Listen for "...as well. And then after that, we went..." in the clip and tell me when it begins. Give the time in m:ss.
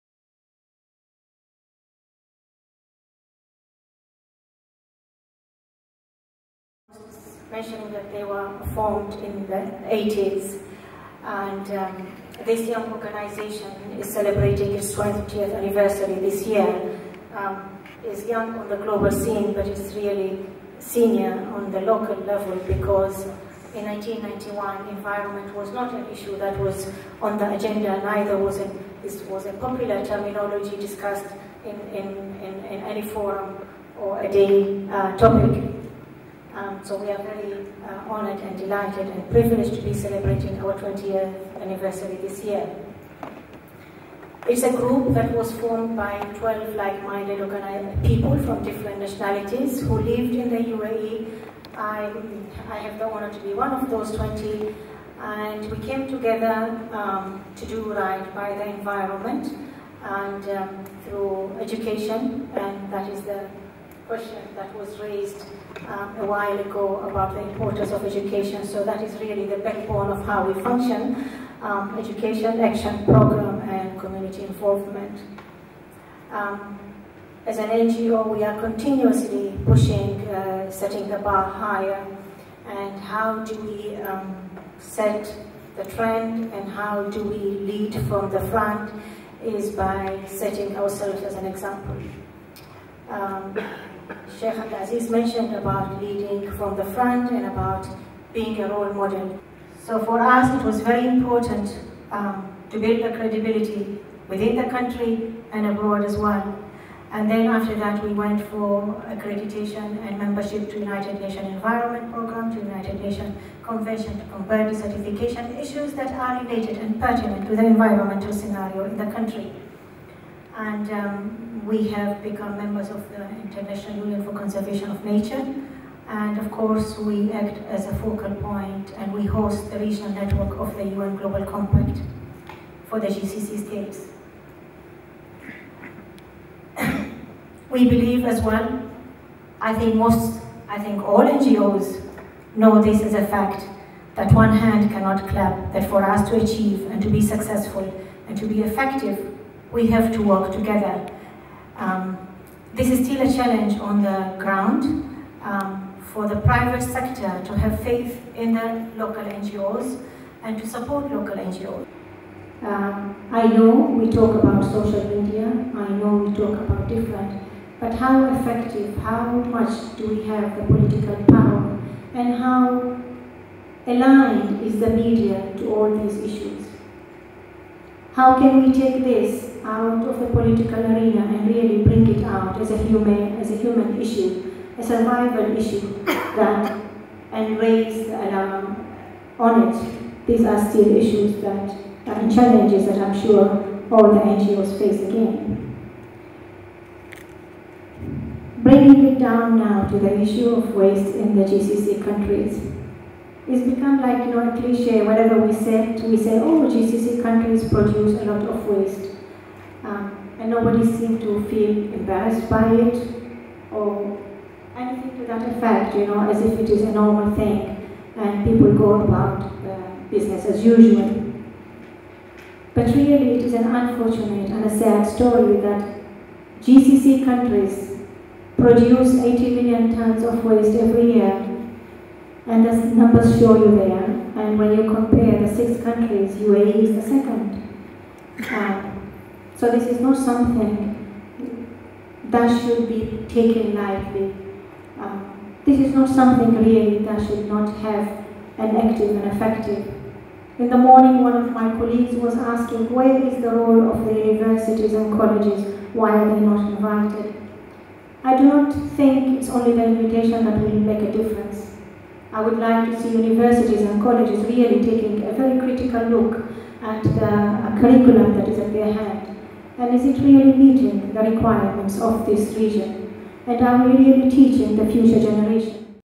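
1:46.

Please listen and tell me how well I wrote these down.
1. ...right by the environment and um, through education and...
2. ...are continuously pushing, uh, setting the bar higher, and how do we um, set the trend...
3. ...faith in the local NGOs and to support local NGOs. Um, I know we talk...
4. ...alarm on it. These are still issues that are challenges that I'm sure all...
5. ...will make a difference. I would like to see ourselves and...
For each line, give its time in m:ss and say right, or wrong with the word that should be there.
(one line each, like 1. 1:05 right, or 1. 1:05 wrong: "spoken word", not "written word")
1. 0:57 right
2. 1:18 right
3. 2:37 right
4. 3:08 right
5. 4:20 wrong: "universities", not "ourselves".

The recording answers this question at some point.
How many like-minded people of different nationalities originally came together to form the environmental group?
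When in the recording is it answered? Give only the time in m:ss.
0:46.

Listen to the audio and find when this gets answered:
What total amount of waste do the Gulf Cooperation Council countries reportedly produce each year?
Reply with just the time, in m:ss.
3:49.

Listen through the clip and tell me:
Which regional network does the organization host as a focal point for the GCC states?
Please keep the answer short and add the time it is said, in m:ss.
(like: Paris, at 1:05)
UN Global Compact, at 2:10.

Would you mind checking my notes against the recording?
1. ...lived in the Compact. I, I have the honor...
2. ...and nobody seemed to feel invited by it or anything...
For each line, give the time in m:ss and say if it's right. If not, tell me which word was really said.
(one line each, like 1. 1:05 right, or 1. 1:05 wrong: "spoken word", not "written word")
1. 0:49 wrong: "UAE", not "Compact"
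2. 3:30 wrong: "embarrassed", not "invited".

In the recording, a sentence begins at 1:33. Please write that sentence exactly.
Um, Sheikh Abdulaziz mentioned about leading from the front and about being a role model.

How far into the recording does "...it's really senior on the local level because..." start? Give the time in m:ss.
0:19.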